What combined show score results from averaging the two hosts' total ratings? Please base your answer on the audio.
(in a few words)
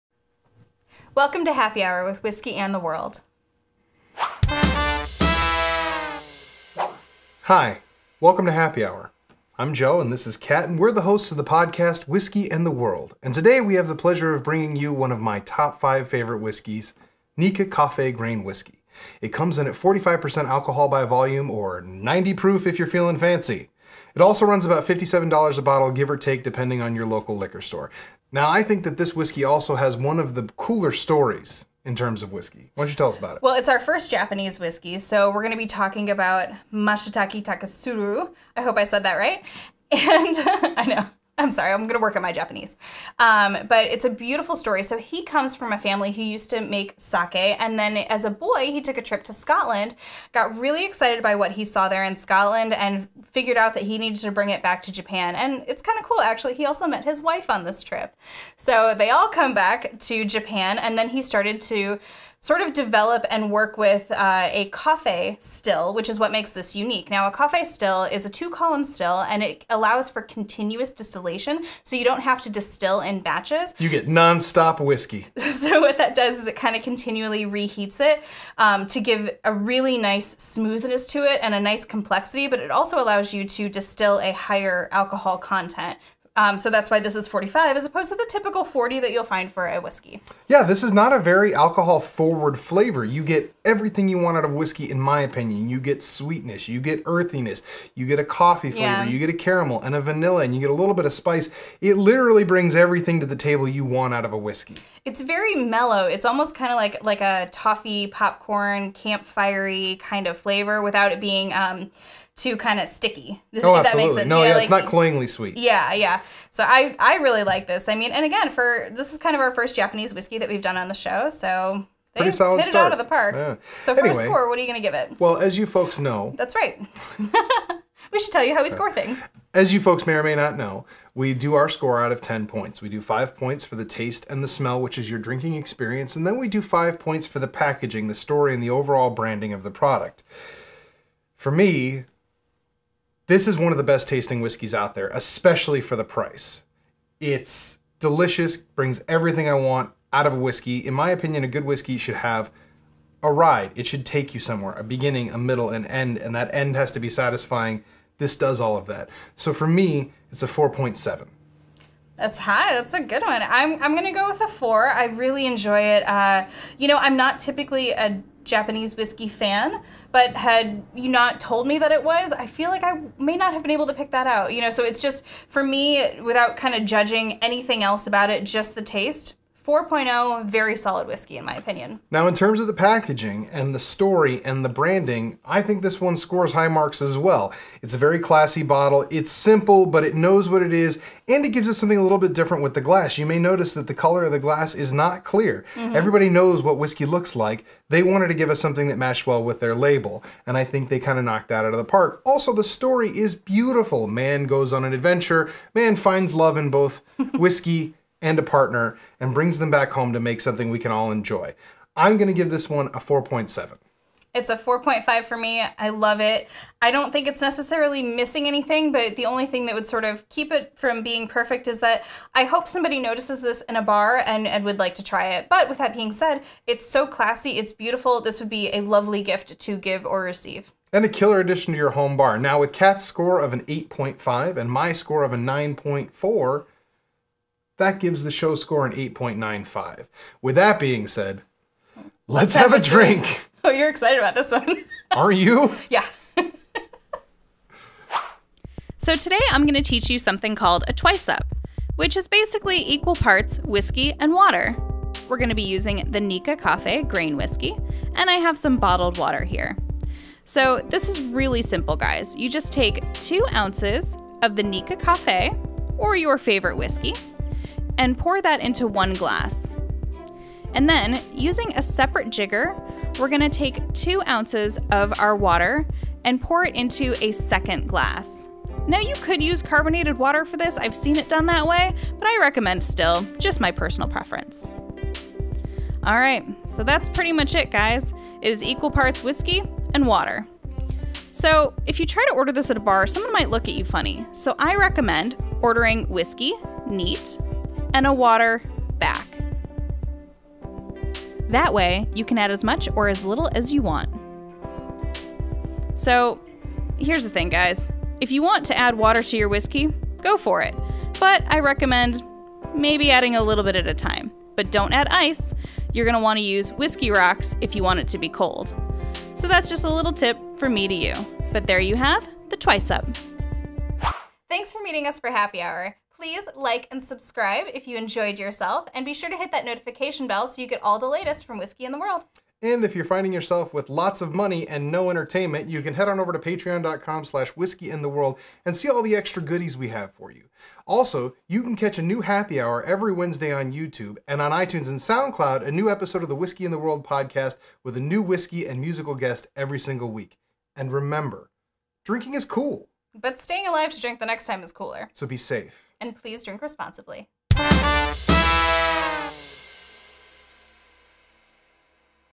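8.95.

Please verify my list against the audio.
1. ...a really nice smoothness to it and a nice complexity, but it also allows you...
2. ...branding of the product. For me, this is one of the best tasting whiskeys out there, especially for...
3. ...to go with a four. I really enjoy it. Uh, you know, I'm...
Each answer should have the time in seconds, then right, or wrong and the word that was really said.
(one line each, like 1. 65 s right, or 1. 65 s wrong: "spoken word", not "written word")
1. 79 s right
2. 139 s right
3. 164 s right.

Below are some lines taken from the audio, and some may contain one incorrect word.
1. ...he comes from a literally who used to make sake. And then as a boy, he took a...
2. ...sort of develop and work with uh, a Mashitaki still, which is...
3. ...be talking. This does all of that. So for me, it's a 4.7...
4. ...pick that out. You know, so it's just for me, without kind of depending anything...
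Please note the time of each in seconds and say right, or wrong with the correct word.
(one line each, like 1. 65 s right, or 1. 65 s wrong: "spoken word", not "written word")
1. 44 s wrong: "family", not "literally"
2. 62 s wrong: "Coffey", not "Mashitaki"
3. 156 s wrong: "satisfying", not "talking"
4. 173 s wrong: "judging", not "depending".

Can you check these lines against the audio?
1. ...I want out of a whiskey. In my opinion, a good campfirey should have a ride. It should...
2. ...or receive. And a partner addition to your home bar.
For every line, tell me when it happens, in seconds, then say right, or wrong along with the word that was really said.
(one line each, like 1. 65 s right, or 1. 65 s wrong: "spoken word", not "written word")
1. 149 s wrong: "whiskey", not "campfirey"
2. 230 s wrong: "killer", not "partner".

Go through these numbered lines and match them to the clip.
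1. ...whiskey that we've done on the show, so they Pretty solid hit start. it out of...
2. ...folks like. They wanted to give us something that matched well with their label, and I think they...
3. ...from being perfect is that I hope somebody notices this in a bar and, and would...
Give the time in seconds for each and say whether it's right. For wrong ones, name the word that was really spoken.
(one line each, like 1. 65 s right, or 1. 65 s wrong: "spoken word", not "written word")
1. 120 s right
2. 197 s wrong: "looks", not "folks"
3. 220 s right.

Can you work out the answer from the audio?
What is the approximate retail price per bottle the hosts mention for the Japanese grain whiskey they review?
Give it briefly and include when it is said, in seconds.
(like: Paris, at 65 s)
$57, at 24 s.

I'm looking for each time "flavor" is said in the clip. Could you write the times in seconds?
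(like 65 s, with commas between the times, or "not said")
92 s, 98 s, 110 s.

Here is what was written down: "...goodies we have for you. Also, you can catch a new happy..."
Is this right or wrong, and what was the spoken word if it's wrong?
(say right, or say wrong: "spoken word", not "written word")
right.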